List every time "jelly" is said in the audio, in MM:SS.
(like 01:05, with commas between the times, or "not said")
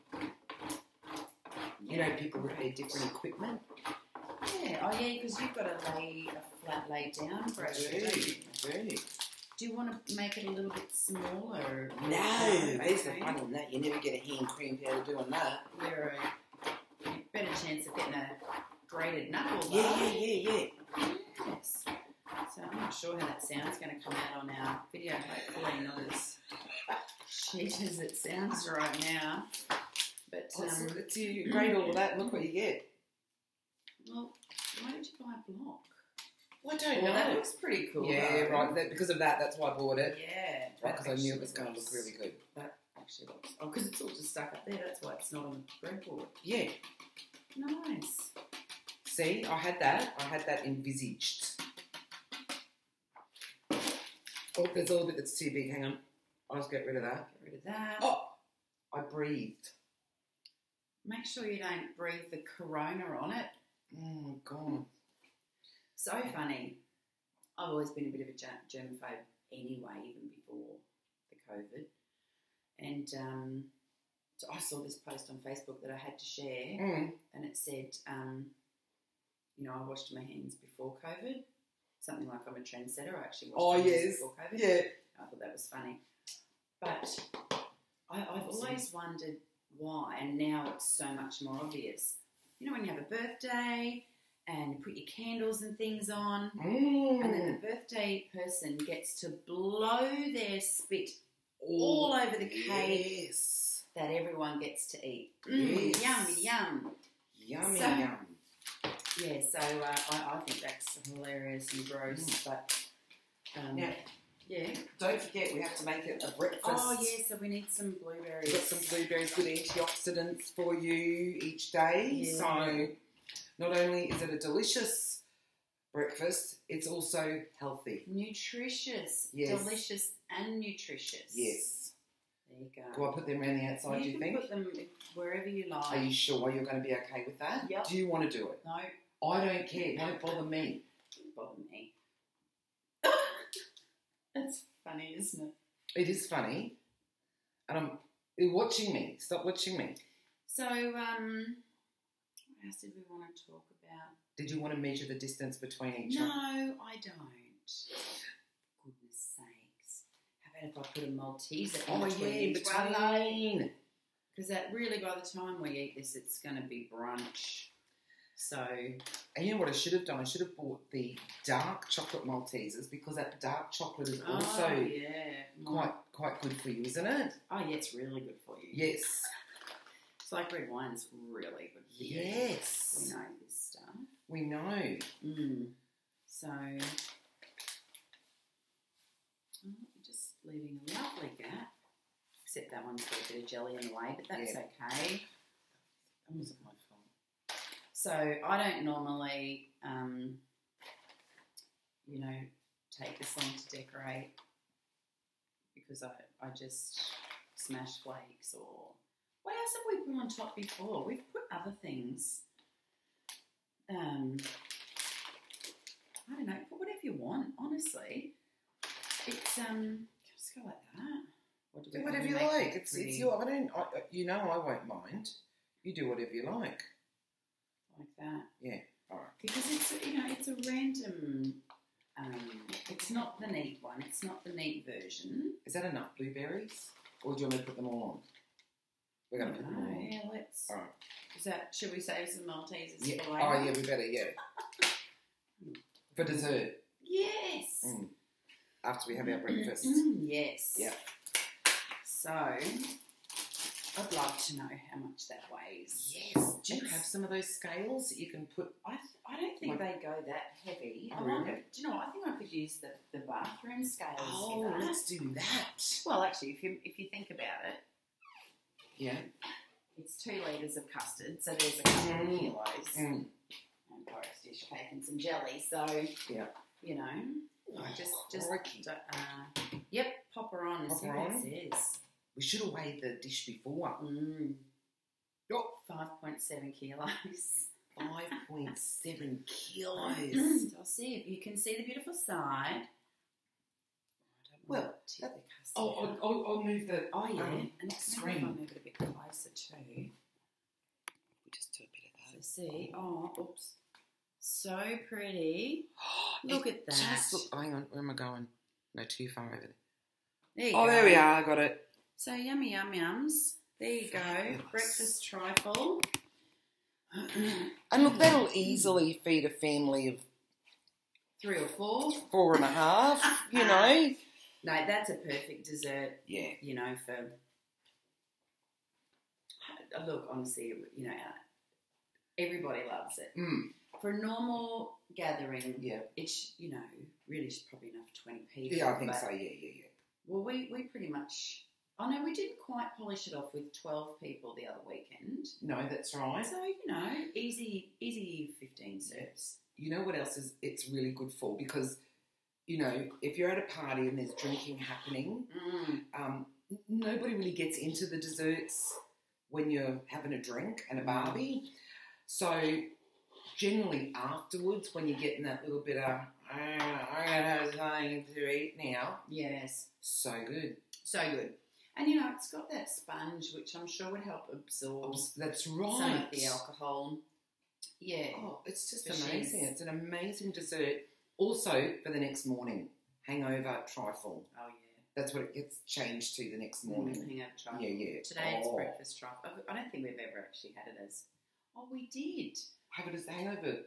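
03:13, 04:35.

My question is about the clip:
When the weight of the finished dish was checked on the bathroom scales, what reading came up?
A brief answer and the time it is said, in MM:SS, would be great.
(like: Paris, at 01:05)
5.7 kilos, at 04:45.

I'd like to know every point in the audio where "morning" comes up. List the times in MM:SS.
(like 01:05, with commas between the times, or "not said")
06:22, 06:26.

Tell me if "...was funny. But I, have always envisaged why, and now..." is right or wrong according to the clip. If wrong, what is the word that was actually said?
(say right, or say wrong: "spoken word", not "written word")
wrong: "wondered", not "envisaged".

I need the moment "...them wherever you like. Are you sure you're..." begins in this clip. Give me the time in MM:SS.
02:14.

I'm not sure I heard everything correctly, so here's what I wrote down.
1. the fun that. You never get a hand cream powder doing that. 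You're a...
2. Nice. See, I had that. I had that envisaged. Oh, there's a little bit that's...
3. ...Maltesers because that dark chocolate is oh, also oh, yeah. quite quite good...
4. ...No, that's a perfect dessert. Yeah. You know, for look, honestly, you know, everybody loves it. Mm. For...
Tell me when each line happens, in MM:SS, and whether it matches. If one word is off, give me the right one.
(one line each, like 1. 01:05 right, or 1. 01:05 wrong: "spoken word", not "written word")
1. 00:12 right
2. 00:47 right
3. 02:52 right
4. 05:24 right.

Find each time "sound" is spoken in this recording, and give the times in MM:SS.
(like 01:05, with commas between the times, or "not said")
00:23, 00:28.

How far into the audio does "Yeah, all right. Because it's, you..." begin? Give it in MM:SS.
03:48.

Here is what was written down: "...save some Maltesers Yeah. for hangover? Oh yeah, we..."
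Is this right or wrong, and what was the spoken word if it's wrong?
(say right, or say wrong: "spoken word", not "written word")
wrong: "later", not "hangover".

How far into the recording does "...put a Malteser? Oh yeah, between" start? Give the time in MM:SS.
02:40.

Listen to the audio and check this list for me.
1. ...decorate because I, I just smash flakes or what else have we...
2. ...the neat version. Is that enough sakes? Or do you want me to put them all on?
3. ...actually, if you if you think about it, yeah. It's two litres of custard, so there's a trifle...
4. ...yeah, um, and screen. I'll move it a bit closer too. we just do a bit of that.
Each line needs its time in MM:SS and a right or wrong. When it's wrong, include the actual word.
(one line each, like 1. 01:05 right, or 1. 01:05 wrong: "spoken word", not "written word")
1. 03:23 right
2. 03:54 wrong: "blueberries", not "sakes"
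3. 04:26 wrong: "couple", not "trifle"
4. 04:57 right.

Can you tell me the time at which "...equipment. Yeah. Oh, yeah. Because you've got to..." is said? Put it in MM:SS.
00:03.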